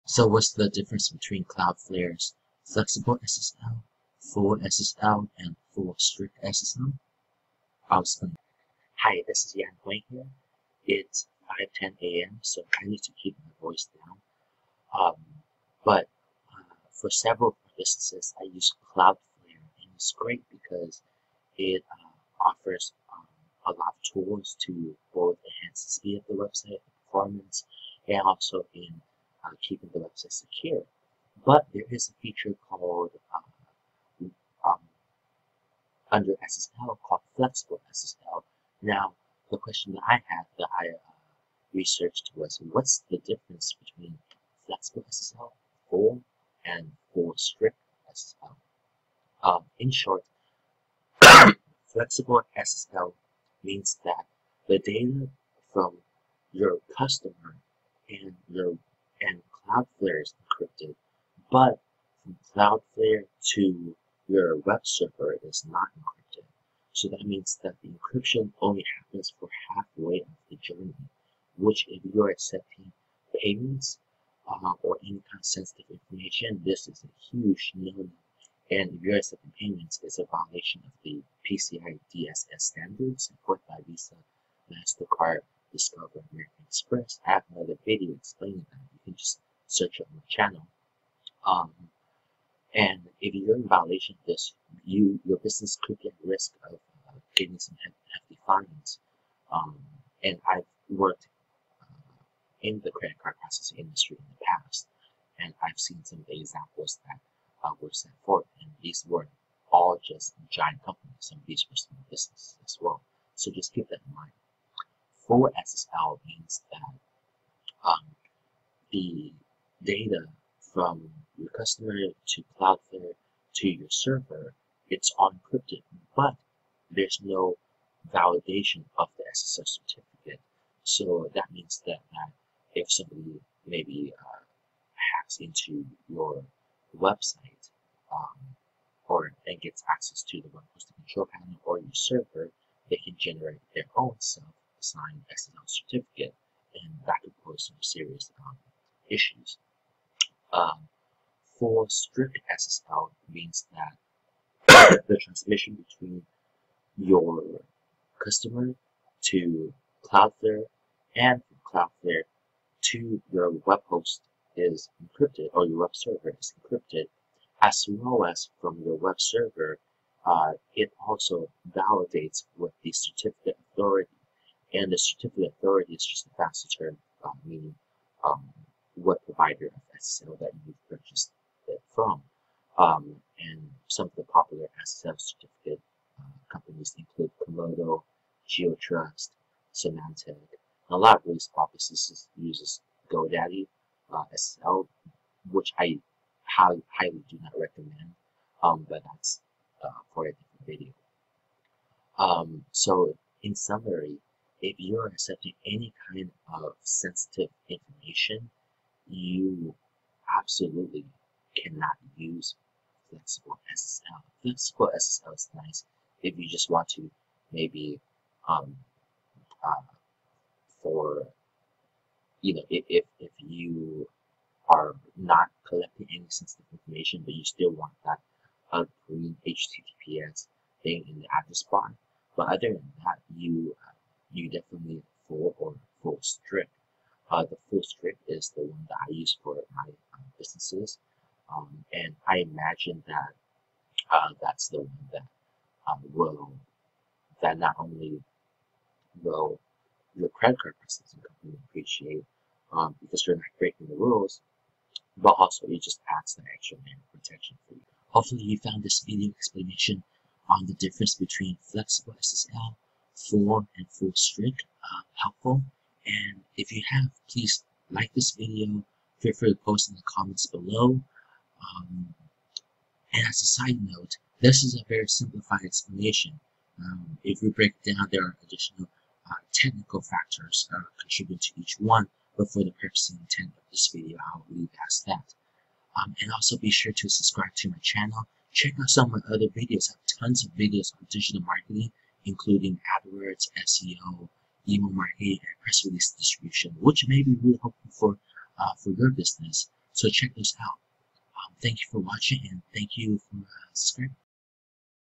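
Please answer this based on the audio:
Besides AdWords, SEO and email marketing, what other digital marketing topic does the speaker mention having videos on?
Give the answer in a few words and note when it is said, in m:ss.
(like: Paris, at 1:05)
Press release distribution, at 4:55.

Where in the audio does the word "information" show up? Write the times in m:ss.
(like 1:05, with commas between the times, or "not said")
1:15, 3:27, 3:46.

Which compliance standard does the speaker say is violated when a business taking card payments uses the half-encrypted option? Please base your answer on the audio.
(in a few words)
PCI DSS.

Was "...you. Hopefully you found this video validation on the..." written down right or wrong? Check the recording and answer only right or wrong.
wrong.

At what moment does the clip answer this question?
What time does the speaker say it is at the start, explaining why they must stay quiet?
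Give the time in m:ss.
0:11.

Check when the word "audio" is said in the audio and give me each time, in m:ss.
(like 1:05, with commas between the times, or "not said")
not said.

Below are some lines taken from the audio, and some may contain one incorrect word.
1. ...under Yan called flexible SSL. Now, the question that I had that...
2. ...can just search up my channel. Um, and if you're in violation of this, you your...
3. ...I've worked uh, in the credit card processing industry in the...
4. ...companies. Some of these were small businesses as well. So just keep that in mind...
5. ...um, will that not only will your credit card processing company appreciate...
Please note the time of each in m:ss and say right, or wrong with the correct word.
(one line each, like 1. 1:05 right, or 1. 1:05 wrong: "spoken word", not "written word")
1. 0:36 wrong: "SSL", not "Yan"
2. 1:29 right
3. 1:40 right
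4. 1:50 right
5. 4:05 right.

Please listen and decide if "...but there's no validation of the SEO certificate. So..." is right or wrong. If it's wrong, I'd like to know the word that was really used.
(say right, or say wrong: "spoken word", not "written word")
wrong: "SSL", not "SEO".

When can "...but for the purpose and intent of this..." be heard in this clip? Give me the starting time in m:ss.
4:42.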